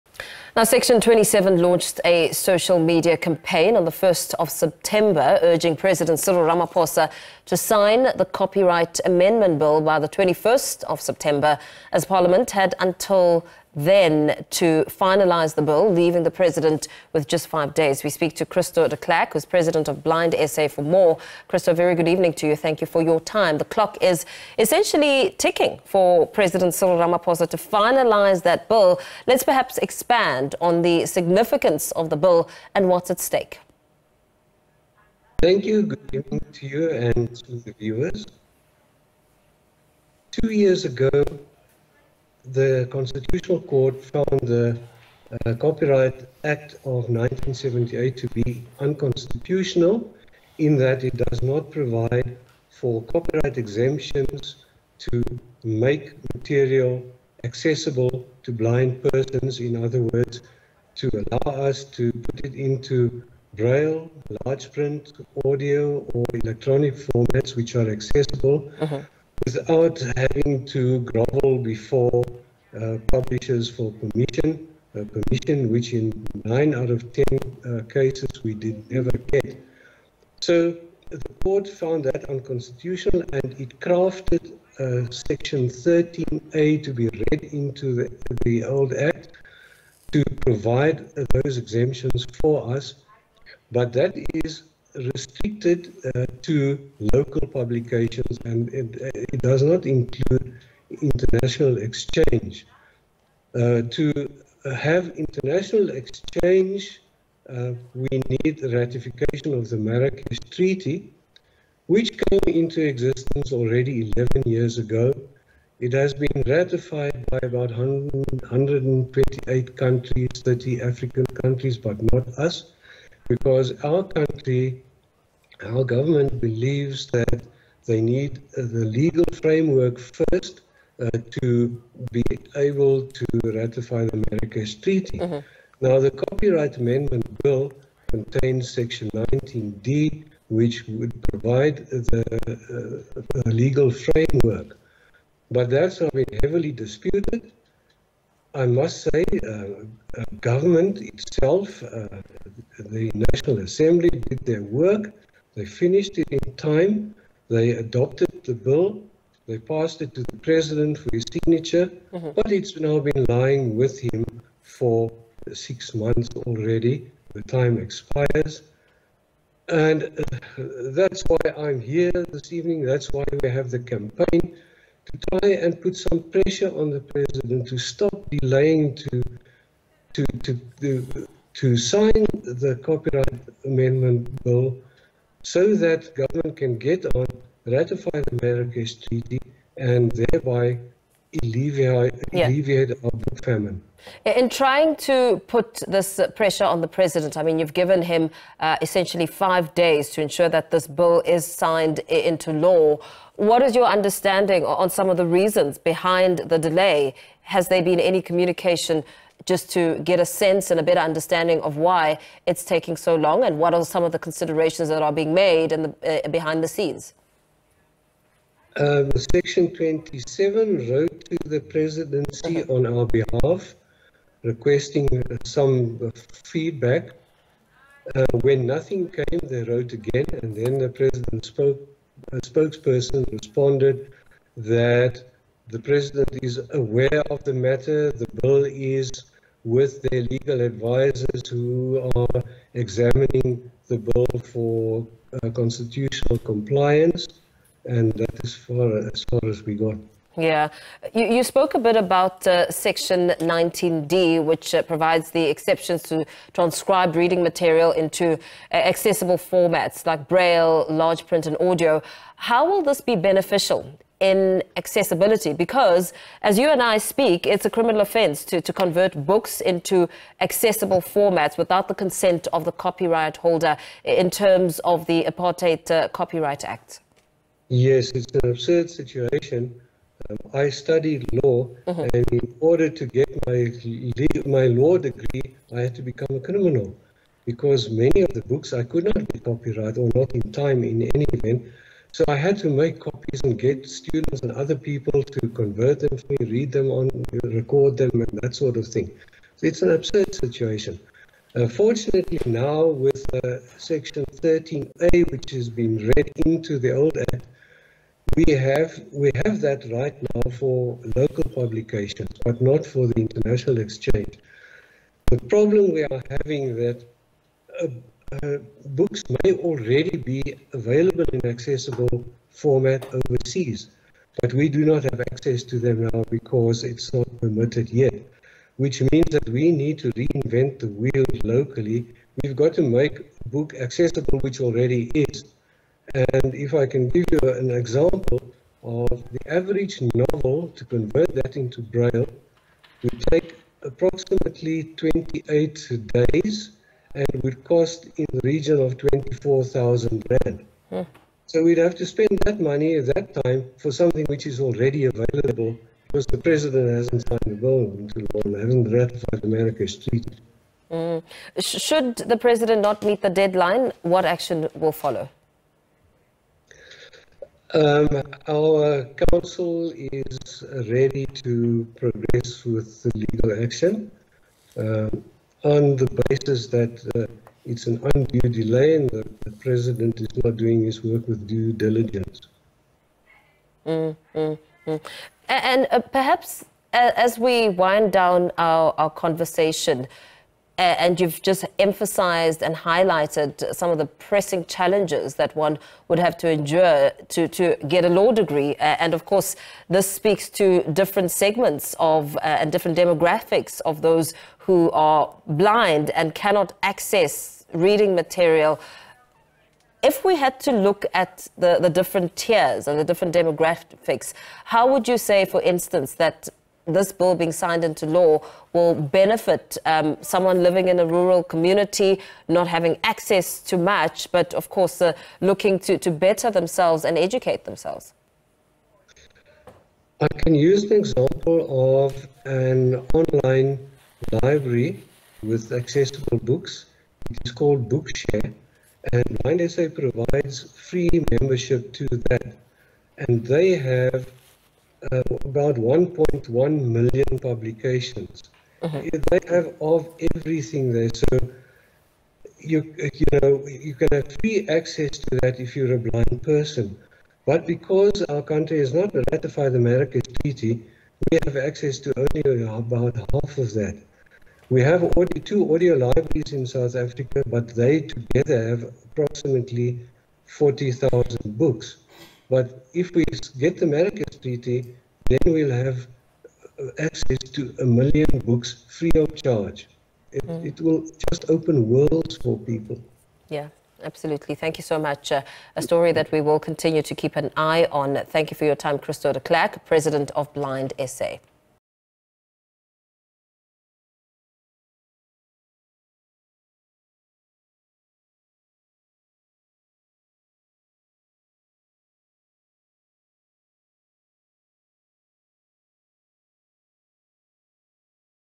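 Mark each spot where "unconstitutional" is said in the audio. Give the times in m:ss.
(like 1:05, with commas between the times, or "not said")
0:48, 1:22.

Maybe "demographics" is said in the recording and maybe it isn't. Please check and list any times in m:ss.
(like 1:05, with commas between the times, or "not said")
6:42, 6:53.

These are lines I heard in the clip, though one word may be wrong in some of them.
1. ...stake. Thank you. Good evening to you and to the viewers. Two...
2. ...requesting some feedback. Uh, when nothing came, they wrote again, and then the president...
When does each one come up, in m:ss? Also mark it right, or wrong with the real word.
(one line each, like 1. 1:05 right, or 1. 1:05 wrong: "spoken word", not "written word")
1. 0:33 right
2. 3:44 right.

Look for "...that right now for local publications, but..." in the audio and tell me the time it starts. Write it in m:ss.
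5:09.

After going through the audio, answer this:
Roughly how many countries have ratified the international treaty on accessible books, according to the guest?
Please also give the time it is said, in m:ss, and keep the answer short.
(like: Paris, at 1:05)
128, at 1:57.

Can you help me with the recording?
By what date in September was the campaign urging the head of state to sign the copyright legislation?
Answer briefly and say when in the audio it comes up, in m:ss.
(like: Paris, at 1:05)
21st of September, at 0:10.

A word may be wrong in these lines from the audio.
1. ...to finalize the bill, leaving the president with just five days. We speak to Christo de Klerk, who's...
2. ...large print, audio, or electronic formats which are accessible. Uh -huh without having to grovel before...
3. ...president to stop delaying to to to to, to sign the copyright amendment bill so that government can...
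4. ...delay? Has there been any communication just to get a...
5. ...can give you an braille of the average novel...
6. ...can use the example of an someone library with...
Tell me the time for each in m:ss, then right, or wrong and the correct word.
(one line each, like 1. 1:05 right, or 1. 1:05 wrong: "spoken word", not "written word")
1. 0:14 right
2. 1:04 right
3. 2:56 right
4. 3:26 right
5. 5:36 wrong: "example", not "braille"
6. 7:10 wrong: "online", not "someone".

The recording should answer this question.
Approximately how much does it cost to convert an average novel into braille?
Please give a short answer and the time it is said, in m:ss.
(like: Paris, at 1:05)
24,000 Rand, at 5:48.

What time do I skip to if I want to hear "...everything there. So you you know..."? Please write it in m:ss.
7:30.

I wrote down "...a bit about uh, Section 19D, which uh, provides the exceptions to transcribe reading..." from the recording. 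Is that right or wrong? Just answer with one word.
right.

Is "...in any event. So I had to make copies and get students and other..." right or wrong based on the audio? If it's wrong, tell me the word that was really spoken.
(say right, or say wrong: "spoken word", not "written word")
right.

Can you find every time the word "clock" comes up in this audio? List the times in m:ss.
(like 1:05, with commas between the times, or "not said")
0:23.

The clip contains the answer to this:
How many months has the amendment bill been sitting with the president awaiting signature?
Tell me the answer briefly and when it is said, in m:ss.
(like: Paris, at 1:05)
6, at 2:45.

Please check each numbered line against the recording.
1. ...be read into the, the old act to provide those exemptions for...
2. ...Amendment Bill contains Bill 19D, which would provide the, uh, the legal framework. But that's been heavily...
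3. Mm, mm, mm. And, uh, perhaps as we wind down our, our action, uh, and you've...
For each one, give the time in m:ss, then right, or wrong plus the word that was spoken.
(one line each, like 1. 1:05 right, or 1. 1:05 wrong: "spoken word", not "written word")
1. 1:26 right
2. 2:16 wrong: "Section", not "Bill"
3. 6:23 wrong: "conversation", not "action".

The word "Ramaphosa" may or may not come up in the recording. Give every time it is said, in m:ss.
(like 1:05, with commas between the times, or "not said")
0:06, 0:26.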